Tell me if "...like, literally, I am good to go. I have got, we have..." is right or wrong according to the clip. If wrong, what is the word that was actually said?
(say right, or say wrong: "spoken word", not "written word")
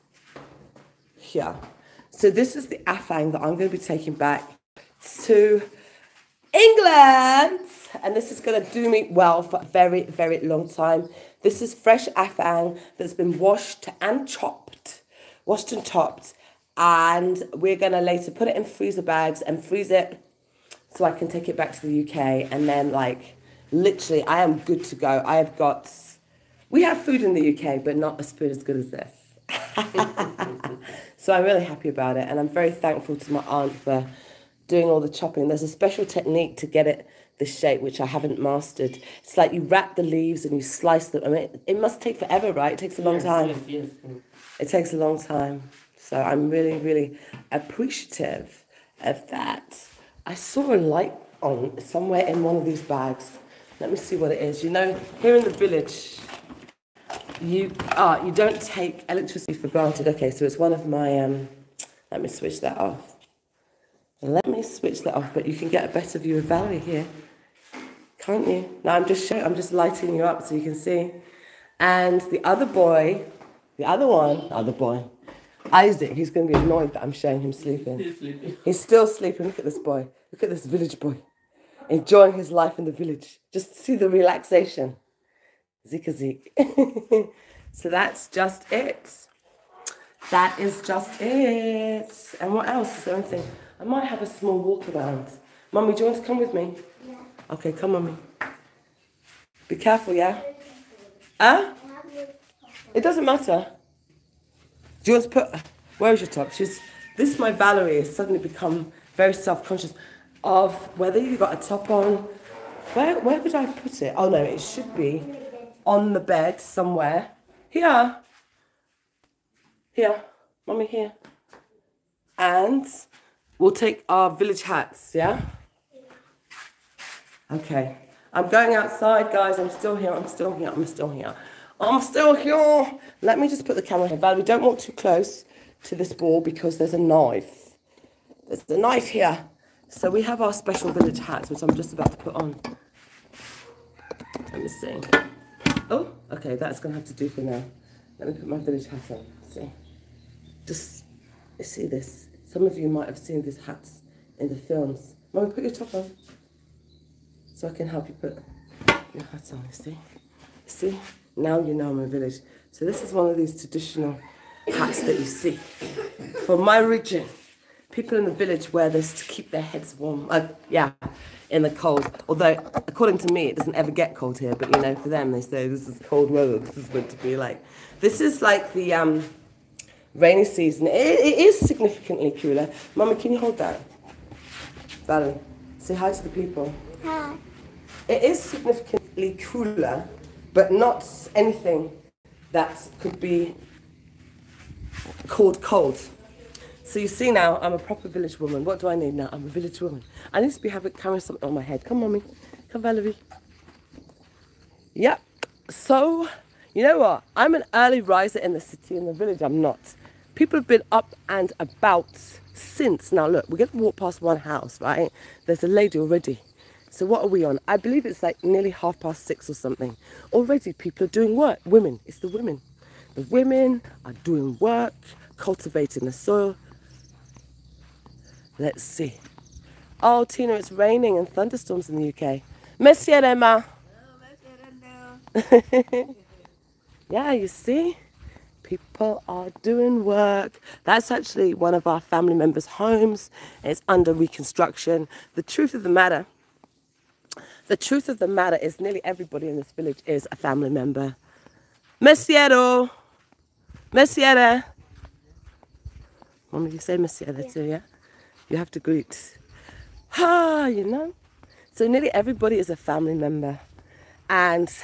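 right.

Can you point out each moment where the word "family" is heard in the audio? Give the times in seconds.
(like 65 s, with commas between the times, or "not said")
242 s, 250 s, 262 s.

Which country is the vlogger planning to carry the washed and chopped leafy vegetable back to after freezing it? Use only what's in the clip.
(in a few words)
England.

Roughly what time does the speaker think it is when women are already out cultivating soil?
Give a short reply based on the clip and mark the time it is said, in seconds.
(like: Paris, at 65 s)
Half past six, at 218 s.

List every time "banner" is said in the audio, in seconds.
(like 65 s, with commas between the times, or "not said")
not said.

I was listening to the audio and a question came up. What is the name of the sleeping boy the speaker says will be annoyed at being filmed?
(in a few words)
Isaac.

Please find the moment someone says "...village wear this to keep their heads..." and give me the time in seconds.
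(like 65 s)
168 s.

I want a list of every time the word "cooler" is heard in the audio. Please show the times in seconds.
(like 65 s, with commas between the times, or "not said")
182 s, 189 s.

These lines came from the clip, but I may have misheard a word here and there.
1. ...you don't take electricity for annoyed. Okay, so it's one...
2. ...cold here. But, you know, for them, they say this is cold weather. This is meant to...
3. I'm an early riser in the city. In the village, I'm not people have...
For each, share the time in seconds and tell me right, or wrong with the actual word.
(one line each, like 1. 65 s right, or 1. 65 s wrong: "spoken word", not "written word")
1. 58 s wrong: "granted", not "annoyed"
2. 174 s right
3. 207 s right.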